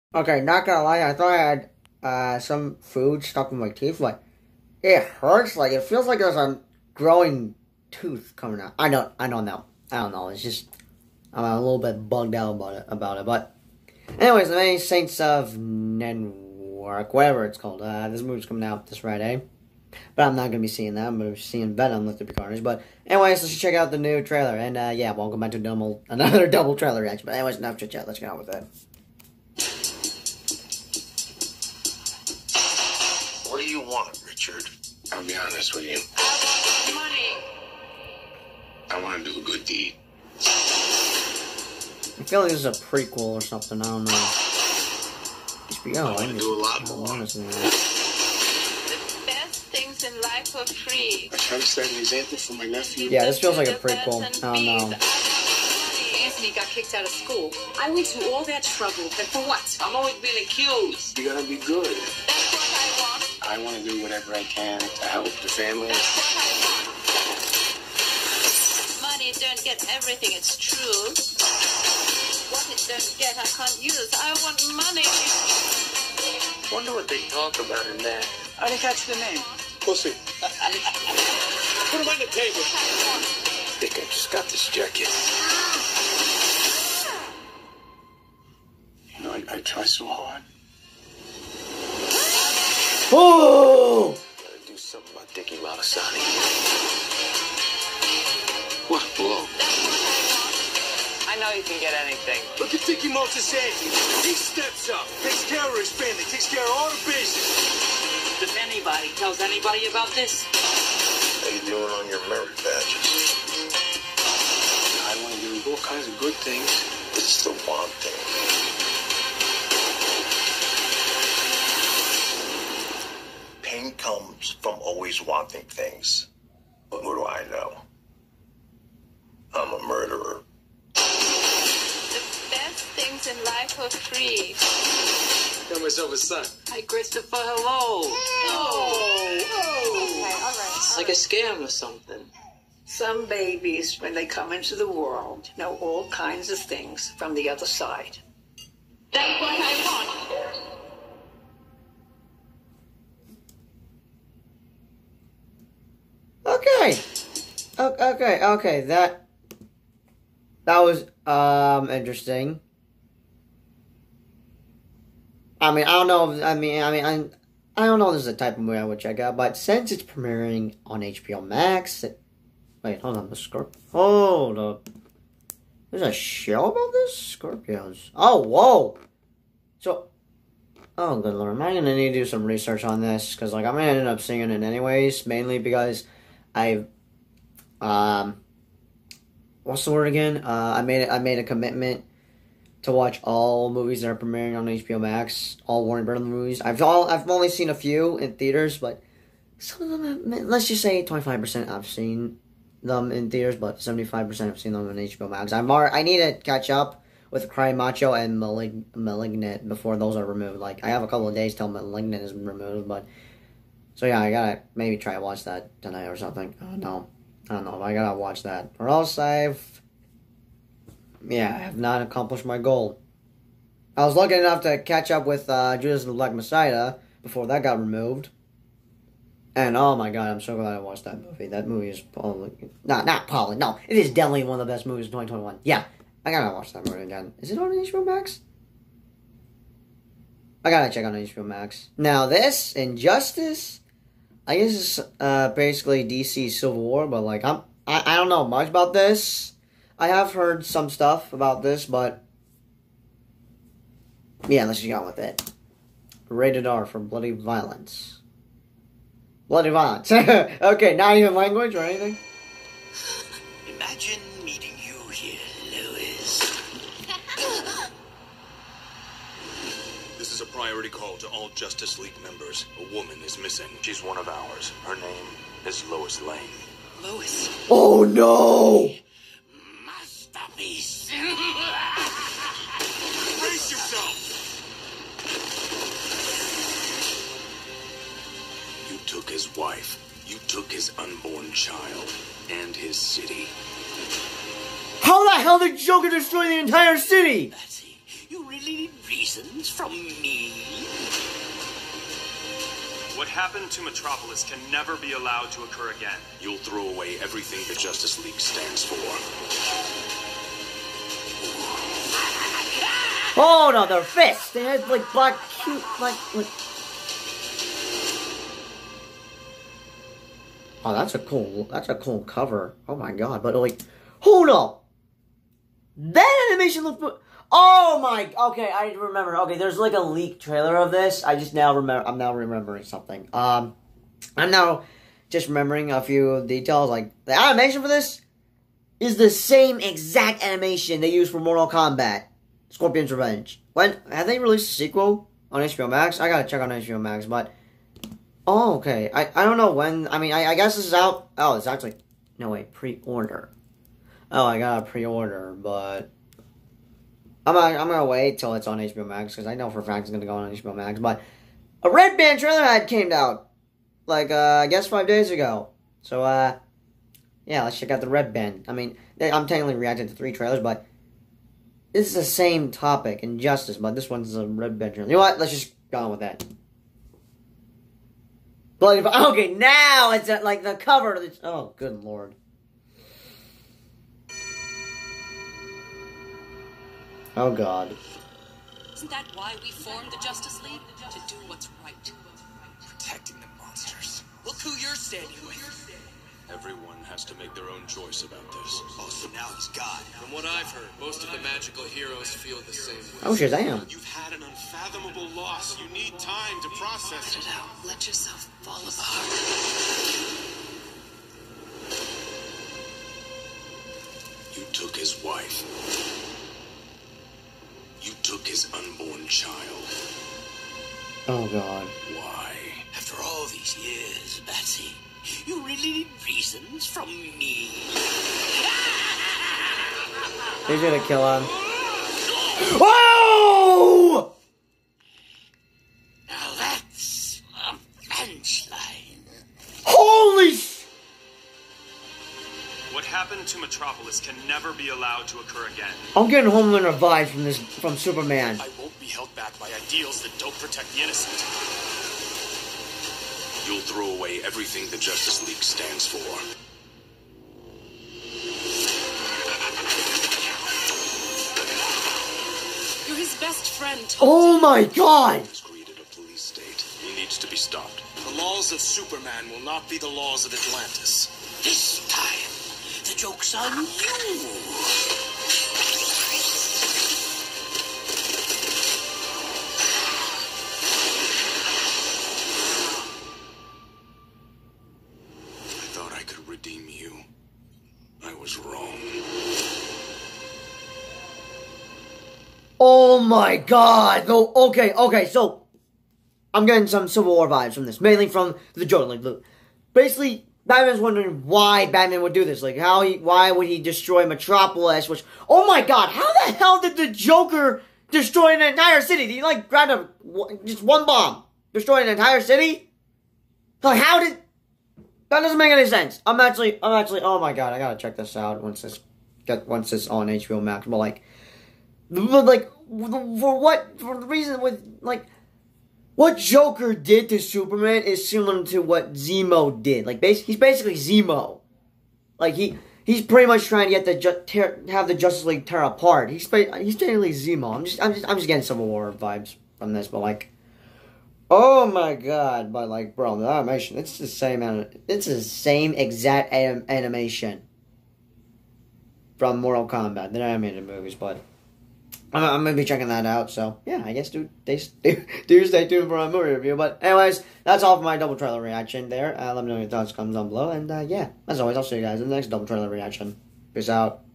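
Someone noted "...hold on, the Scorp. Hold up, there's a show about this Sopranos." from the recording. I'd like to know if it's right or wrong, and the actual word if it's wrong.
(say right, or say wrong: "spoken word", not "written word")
right.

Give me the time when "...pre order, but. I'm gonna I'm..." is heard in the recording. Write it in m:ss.
5:54.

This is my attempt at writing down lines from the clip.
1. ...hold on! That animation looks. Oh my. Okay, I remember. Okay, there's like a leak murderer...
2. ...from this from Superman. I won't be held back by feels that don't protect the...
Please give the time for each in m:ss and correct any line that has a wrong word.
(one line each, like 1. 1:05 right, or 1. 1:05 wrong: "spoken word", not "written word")
1. 5:24 wrong: "trailer", not "murderer"
2. 7:27 wrong: "ideals", not "feels".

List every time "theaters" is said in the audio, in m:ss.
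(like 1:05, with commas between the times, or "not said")
3:18, 3:23.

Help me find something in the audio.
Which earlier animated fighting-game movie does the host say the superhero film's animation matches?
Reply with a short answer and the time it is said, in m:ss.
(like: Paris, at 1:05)
Mortal Kombat: Scorpion's Revenge, at 5:41.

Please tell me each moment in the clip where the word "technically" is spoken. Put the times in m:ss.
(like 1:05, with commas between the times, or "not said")
6:09, 8:56.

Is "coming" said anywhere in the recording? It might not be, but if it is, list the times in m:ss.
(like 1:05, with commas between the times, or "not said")
0:08, 0:18.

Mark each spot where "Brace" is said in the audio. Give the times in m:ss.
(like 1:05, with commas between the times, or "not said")
4:43.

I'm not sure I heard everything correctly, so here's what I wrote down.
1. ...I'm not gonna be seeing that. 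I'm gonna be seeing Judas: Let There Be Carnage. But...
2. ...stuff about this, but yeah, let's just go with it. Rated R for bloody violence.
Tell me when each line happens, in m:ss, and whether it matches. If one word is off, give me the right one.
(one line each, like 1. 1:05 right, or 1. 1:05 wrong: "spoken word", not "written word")
1. 0:20 wrong: "Venom", not "Judas"
2. 4:10 right.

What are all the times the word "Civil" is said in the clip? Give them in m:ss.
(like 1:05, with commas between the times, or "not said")
4:06, 8:17, 8:58.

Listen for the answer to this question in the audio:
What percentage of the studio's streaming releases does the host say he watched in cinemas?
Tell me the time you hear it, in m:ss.
3:21.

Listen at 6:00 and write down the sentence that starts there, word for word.
But a Red Band trailer ad came out like uh, I guess five days ago.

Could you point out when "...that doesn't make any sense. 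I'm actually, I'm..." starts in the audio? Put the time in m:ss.
8:35.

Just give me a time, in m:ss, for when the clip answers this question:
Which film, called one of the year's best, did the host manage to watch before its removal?
3:45.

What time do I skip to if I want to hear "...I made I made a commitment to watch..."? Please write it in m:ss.
3:10.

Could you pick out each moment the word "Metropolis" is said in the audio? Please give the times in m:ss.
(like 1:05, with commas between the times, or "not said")
5:03, 7:23, 8:24.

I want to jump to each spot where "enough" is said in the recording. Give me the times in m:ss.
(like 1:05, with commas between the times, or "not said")
0:27, 3:44.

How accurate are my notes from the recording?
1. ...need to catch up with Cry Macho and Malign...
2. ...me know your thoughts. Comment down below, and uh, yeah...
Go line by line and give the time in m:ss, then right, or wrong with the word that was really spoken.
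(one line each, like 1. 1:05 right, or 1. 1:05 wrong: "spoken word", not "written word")
1. 3:26 right
2. 9:19 right.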